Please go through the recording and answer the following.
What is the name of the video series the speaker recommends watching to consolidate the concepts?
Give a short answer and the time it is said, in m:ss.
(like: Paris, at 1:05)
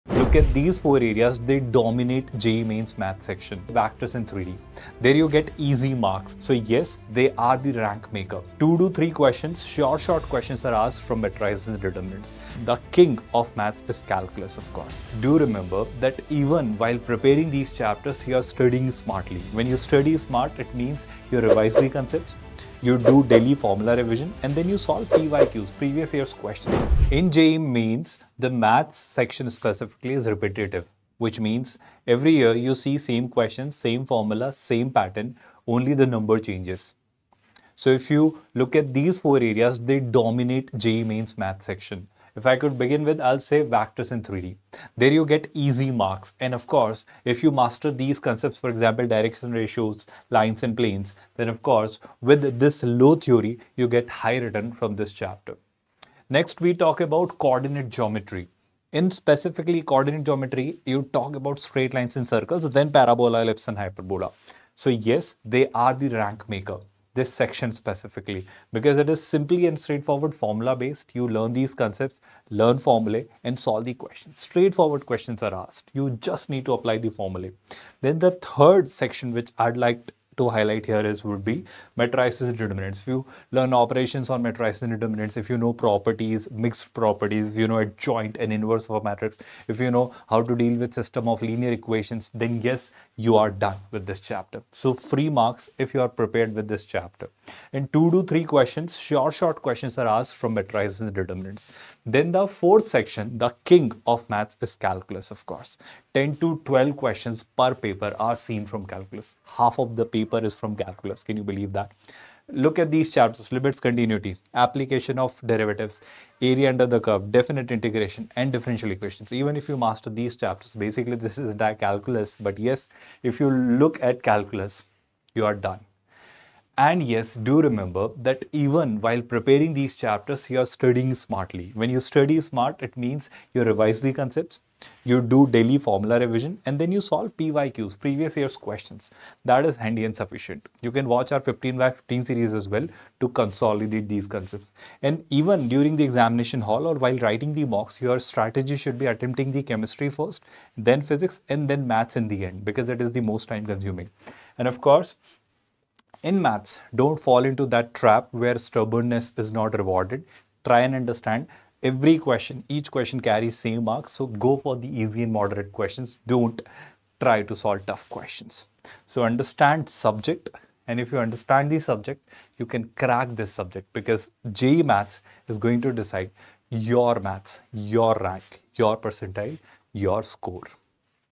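15 by 15, at 2:21.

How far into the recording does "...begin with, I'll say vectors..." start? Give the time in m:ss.
0:42.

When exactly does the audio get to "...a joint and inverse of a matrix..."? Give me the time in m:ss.
1:27.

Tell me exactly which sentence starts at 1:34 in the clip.
So free marks if you are prepared with this chapter.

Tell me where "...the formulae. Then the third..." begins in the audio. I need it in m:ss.
1:16.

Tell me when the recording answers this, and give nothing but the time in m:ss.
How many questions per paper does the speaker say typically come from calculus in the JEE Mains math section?
1:46.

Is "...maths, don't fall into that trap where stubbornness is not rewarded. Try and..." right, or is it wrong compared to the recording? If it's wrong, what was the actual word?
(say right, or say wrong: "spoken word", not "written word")
right.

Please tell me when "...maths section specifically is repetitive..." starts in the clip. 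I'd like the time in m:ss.
0:28.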